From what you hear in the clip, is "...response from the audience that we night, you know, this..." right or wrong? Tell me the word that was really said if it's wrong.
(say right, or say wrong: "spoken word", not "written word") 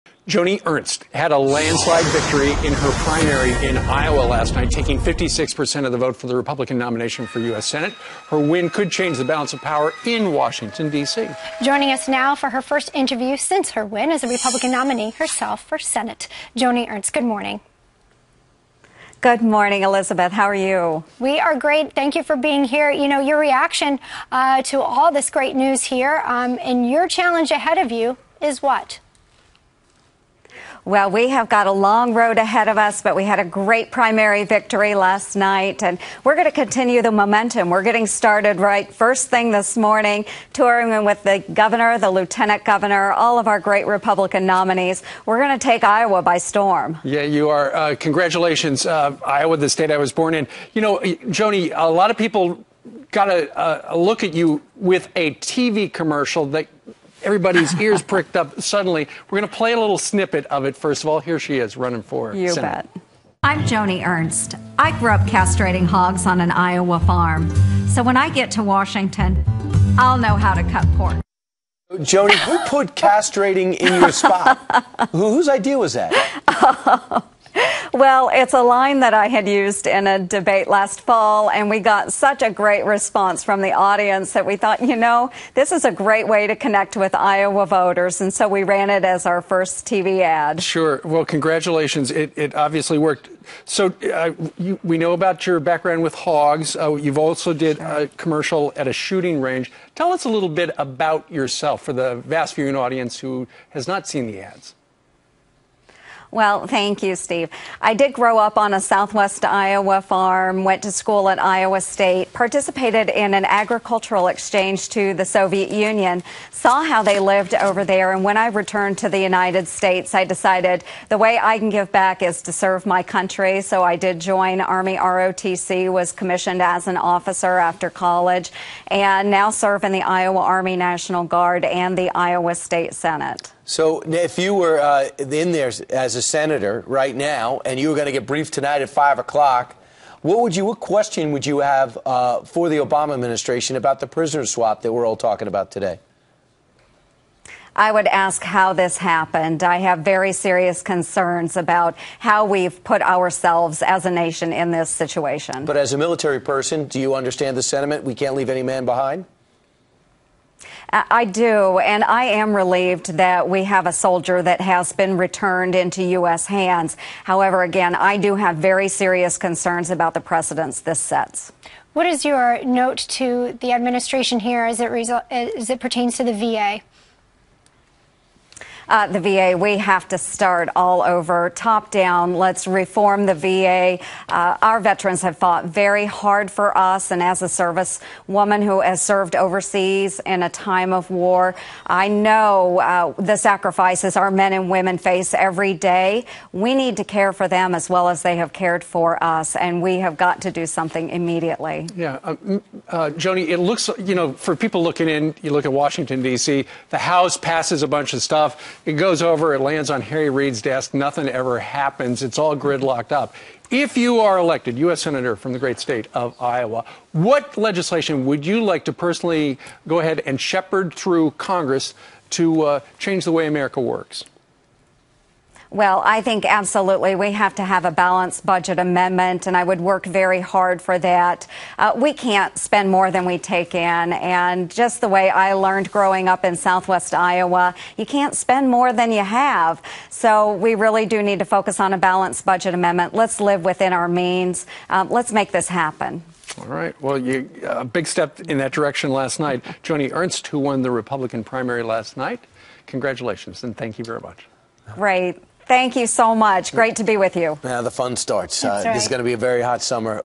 wrong: "thought", not "night".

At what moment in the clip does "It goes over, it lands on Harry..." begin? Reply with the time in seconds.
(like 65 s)
208 s.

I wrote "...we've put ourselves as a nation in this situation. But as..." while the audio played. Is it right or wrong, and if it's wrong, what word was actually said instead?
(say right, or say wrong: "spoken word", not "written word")
right.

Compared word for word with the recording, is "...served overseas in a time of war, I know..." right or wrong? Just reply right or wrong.
right.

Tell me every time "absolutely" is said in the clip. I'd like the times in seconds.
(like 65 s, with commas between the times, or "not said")
226 s.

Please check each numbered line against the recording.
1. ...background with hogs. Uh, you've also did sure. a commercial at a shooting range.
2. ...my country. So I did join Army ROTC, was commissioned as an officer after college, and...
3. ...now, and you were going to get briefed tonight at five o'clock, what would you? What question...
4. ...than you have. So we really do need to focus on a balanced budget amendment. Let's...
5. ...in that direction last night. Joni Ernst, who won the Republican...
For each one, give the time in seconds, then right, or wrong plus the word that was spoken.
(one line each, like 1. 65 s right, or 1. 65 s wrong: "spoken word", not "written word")
1. 95 s right
2. 122 s right
3. 137 s right
4. 238 s right
5. 248 s right.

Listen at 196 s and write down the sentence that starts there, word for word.
We need to care for them as well as they have cared for us, and we have got to do something immediately.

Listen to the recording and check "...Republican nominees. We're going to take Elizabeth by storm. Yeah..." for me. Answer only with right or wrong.
wrong.